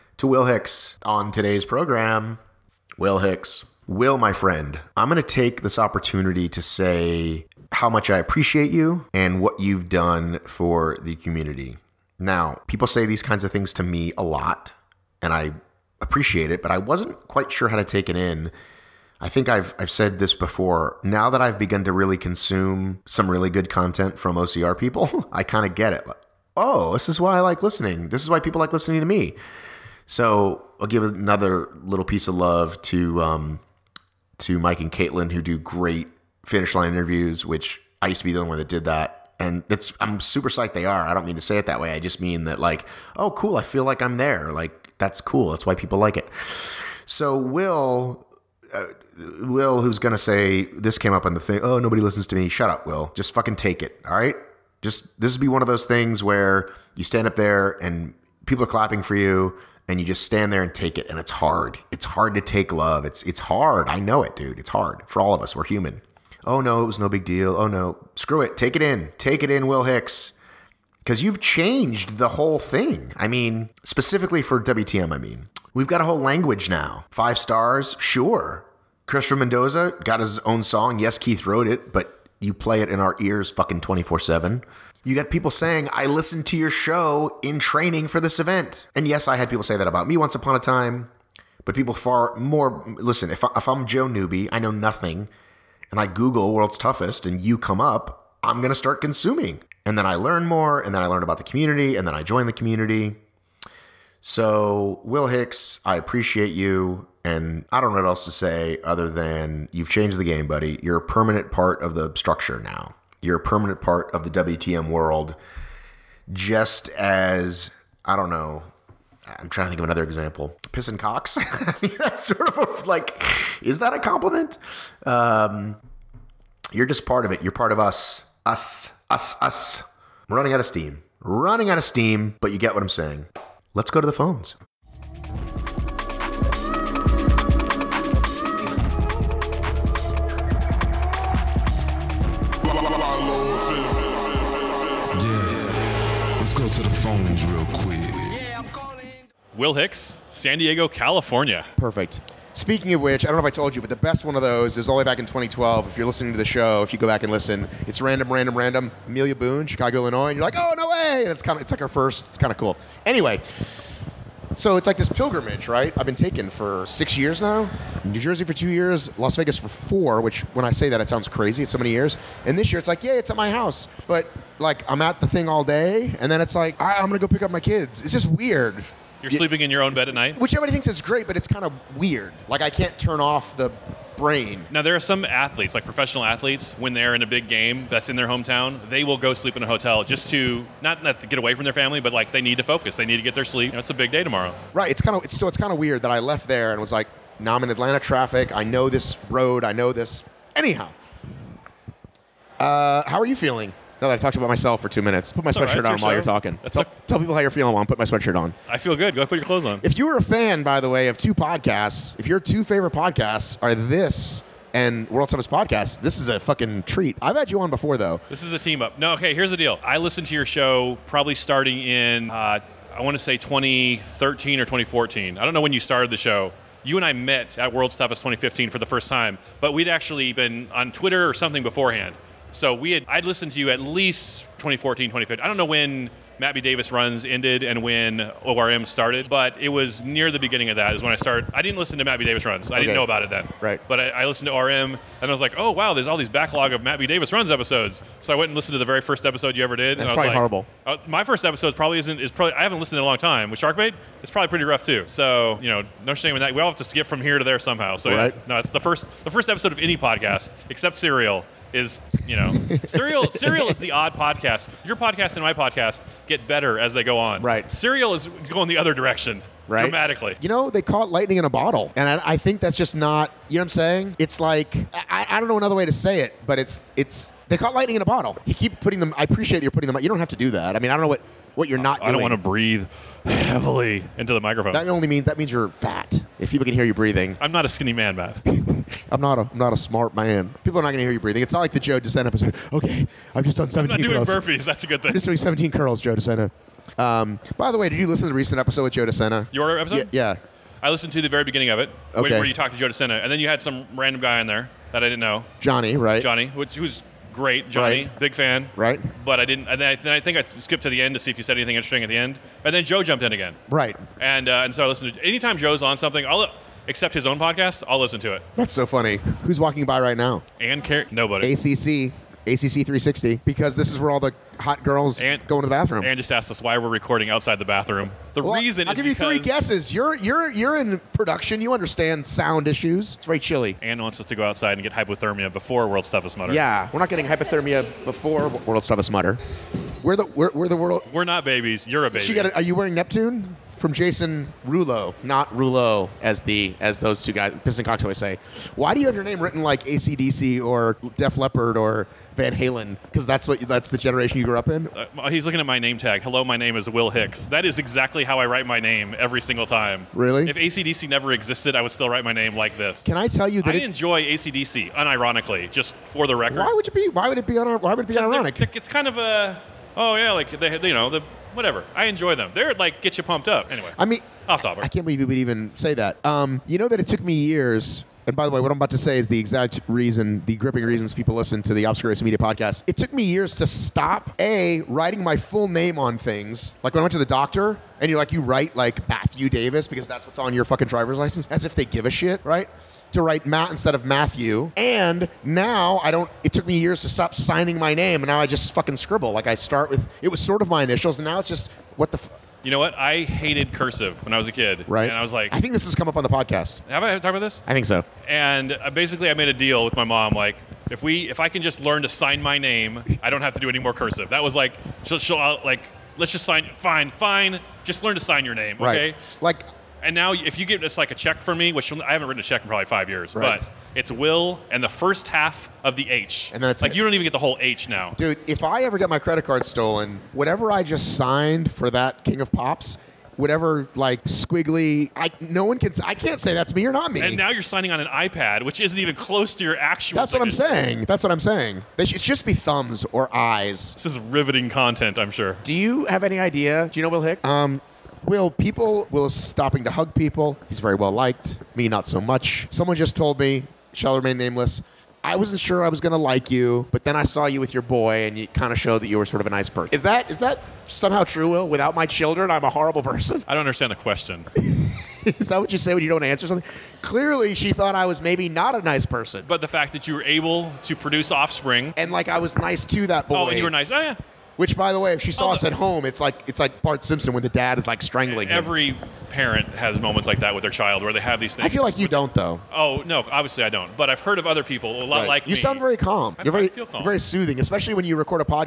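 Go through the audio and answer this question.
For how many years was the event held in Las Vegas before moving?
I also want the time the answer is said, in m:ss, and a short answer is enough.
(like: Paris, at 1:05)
4, at 2:49.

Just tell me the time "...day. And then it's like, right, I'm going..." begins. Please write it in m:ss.
2:55.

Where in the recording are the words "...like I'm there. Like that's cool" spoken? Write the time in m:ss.
0:43.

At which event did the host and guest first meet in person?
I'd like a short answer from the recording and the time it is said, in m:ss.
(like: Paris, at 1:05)
World's Toughest 2015, at 3:47.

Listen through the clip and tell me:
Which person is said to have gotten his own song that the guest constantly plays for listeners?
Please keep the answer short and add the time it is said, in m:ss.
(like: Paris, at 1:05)
Christopher Mendoza, at 1:19.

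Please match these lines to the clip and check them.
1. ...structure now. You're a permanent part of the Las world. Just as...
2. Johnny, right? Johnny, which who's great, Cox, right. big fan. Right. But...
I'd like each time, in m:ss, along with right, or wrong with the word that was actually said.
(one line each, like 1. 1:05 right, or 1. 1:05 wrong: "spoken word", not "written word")
1. 1:52 wrong: "WTM", not "Las"
2. 5:05 wrong: "Johnny", not "Cox".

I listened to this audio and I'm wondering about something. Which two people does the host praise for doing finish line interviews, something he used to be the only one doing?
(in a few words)
Mike and Caitlin.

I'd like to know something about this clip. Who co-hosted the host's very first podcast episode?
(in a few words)
Sharkbait.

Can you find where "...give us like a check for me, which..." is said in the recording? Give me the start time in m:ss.
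7:00.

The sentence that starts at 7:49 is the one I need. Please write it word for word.
But the fact that you were able to produce offspring.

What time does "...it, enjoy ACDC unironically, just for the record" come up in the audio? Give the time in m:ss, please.
6:03.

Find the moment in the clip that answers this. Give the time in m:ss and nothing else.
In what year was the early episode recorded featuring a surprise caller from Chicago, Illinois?
2:35.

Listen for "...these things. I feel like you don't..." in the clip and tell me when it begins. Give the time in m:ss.
8:01.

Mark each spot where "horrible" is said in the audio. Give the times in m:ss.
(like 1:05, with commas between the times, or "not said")
4:10, 7:42.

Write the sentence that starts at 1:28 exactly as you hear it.
And yes, I had people say that about me once upon a time, but people far more.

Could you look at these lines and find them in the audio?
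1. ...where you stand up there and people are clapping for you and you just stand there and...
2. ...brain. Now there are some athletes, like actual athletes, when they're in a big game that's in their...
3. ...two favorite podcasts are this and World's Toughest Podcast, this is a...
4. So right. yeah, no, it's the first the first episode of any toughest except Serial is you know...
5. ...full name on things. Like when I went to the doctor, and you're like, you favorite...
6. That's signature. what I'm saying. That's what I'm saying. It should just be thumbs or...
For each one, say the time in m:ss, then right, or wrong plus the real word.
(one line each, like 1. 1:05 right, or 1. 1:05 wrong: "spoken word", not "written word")
1. 0:56 right
2. 3:04 wrong: "professional", not "actual"
3. 3:32 right
4. 4:17 wrong: "podcast", not "toughest"
5. 6:25 wrong: "write", not "favorite"
6. 7:20 right.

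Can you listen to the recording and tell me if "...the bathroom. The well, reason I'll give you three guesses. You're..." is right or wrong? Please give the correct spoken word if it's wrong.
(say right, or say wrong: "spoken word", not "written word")
right.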